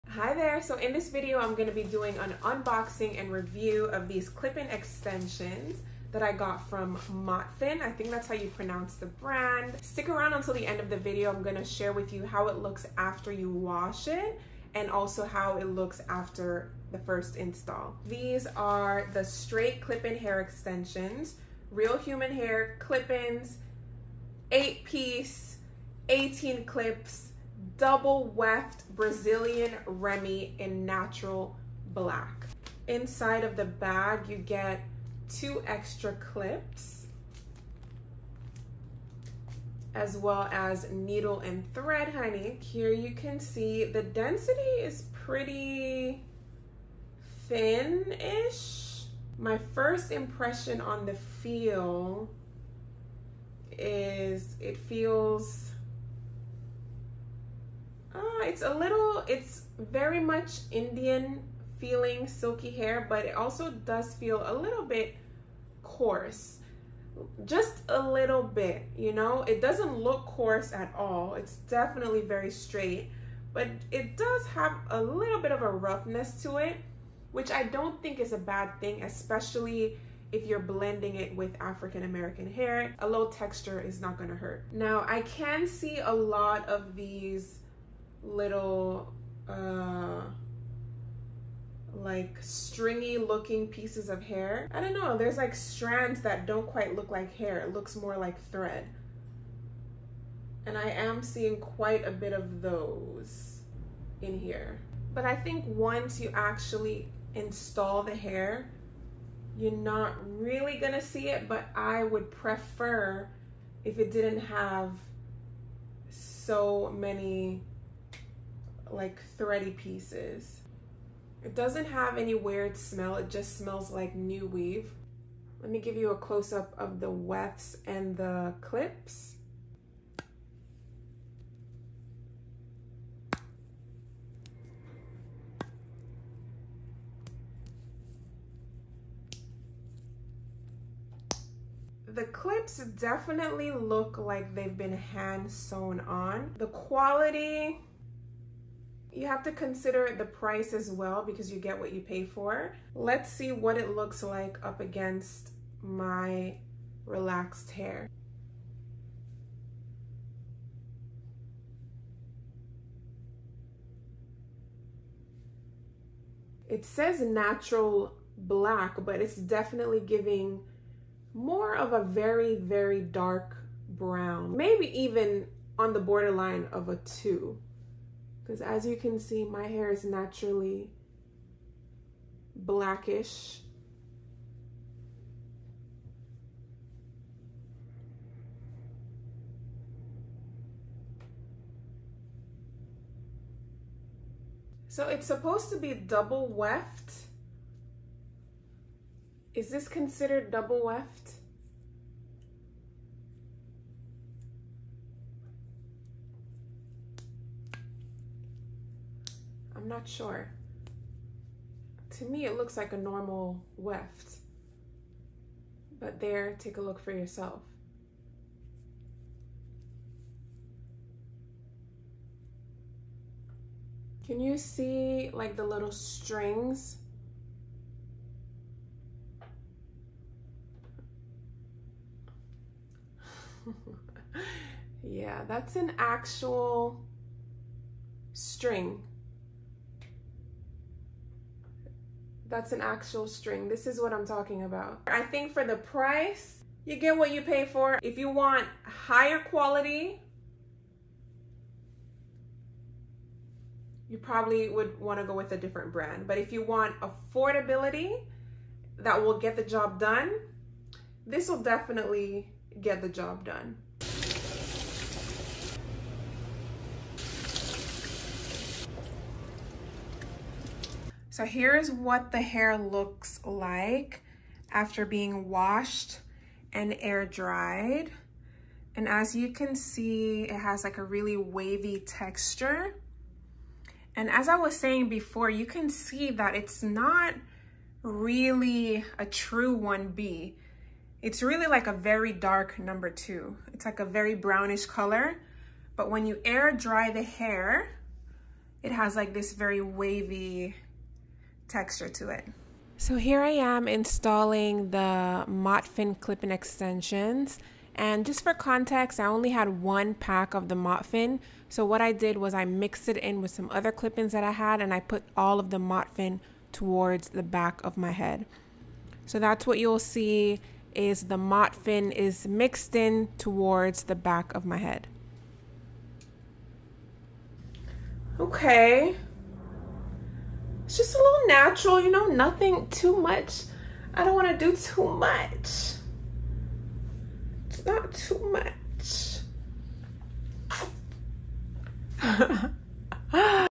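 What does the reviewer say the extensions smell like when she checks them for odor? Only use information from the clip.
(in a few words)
New weave.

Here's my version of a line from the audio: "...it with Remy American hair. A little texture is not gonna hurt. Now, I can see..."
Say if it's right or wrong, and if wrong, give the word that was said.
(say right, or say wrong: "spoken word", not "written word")
wrong: "African", not "Remy".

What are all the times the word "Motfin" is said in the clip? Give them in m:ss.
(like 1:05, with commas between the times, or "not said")
0:07, 5:05, 5:10, 5:15, 5:21.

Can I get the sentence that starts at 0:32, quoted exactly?
Inside of the bag, you get two extra clips as well as needle and thread, honey.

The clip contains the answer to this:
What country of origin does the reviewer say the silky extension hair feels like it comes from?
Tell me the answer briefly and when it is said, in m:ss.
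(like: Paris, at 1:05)
Indian, at 1:00.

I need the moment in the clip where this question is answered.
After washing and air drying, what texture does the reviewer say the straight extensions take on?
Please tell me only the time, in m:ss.
4:41.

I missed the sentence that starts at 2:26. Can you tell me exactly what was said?
The quality you have to consider the price as well because you get what you pay for.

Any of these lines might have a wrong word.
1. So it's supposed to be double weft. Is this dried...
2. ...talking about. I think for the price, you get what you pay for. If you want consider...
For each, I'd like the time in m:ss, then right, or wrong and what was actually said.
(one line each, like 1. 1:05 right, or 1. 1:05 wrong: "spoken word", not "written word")
1. 3:14 wrong: "considered", not "dried"
2. 4:04 wrong: "higher", not "consider".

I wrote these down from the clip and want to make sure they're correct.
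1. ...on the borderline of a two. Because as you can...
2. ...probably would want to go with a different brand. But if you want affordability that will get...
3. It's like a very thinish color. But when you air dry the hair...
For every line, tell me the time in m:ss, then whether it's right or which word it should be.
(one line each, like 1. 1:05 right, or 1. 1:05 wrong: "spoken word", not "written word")
1. 2:55 right
2. 4:14 right
3. 4:53 wrong: "brownish", not "thinish".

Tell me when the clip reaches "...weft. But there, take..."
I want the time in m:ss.
3:33.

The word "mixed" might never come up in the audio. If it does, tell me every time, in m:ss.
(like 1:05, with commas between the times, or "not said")
5:12, 5:22.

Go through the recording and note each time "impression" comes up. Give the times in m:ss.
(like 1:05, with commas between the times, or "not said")
0:50.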